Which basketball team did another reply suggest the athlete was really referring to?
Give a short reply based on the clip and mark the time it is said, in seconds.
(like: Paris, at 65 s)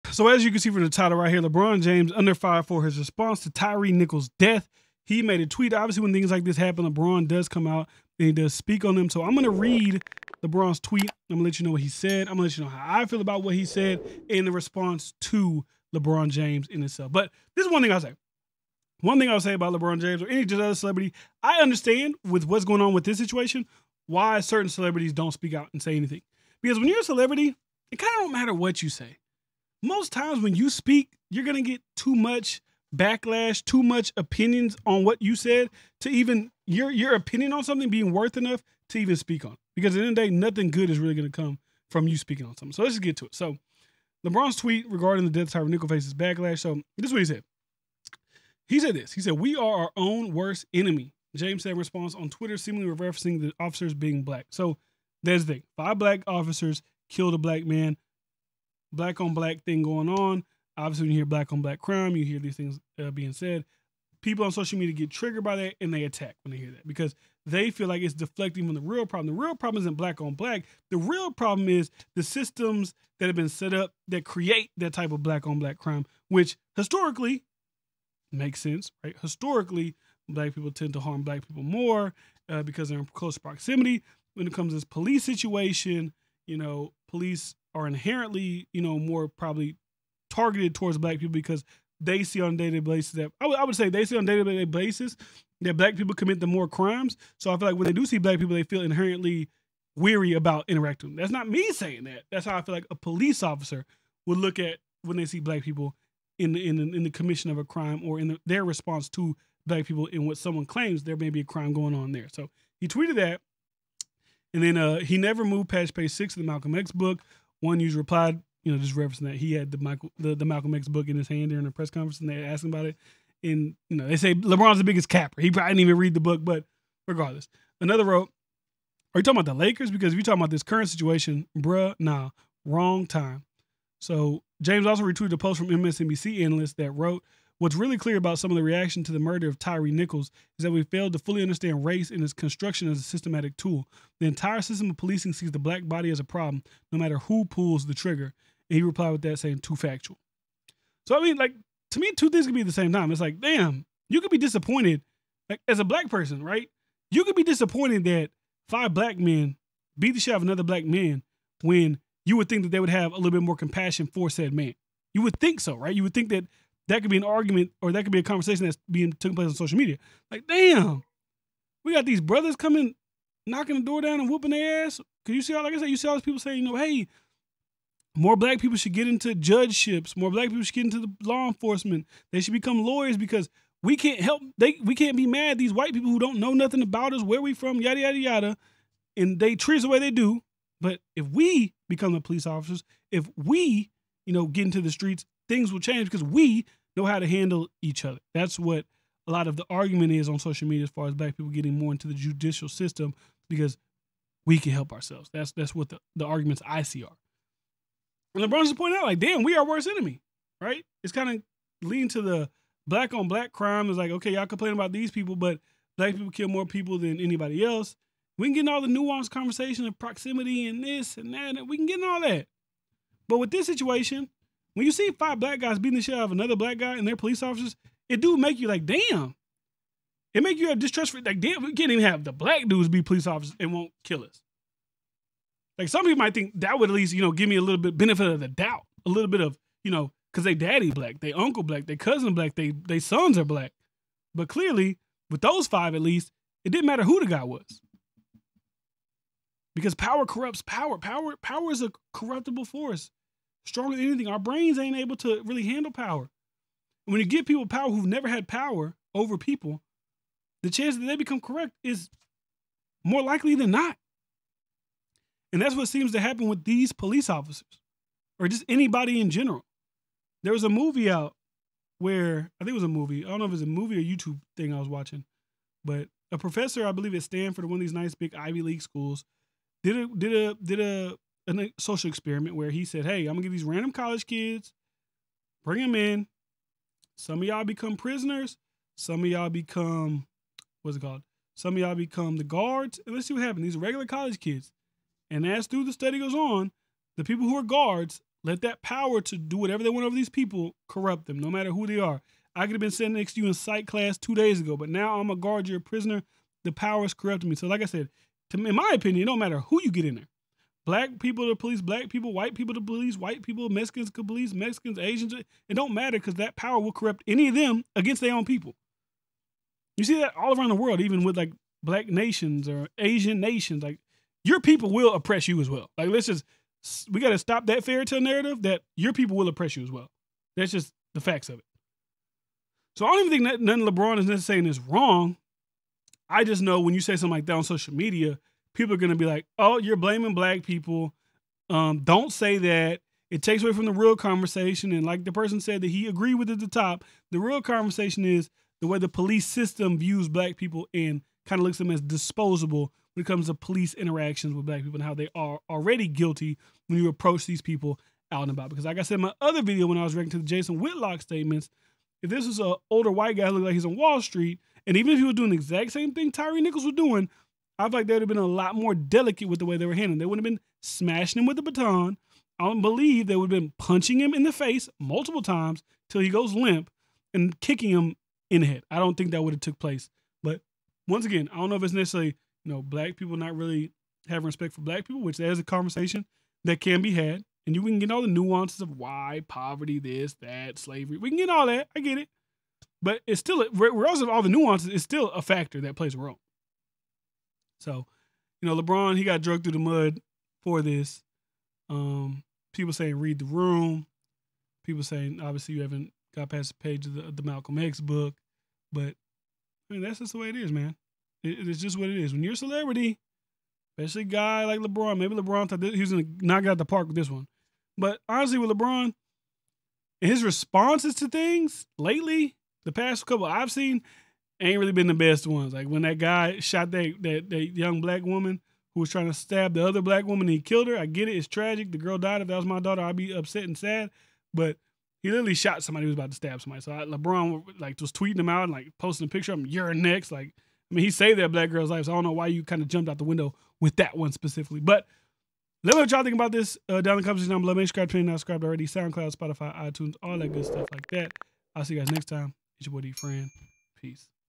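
the Lakers, at 129 s.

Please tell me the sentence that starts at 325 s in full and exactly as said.
Like let's just we got to stop that fairy tale narrative that your people will oppress you as well.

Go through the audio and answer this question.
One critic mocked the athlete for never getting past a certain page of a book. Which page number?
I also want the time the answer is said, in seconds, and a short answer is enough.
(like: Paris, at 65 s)
6, at 115 s.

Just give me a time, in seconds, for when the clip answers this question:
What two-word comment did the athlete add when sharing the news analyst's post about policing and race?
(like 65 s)
149 s.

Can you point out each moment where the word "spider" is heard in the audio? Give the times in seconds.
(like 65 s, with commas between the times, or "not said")
not said.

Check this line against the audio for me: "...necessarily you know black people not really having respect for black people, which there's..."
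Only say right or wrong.
right.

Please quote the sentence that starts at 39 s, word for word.
Because at the end of the day, nothing good is really going to come from you speaking on something.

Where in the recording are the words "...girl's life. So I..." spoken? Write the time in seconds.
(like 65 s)
441 s.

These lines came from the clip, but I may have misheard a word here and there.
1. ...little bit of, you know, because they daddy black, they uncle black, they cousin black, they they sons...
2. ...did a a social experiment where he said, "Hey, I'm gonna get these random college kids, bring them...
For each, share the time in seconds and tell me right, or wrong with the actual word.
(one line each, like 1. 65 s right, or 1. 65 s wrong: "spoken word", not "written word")
1. 239 s right
2. 280 s right.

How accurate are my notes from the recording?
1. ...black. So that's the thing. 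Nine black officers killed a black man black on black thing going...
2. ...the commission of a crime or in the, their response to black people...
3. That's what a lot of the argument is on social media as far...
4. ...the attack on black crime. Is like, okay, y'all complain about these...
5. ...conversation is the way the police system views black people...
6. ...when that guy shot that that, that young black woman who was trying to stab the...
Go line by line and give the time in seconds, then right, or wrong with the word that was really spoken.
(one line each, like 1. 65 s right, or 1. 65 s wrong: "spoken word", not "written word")
1. 54 s wrong: "Five", not "Nine"
2. 107 s right
3. 198 s right
4. 212 s wrong: "black", not "attack"
5. 347 s right
6. 425 s right.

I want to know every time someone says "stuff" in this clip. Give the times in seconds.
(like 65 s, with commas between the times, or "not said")
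450 s.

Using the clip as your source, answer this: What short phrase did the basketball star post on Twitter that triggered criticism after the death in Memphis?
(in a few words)
We are our own worst enemy.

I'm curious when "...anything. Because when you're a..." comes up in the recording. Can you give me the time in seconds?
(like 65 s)
25 s.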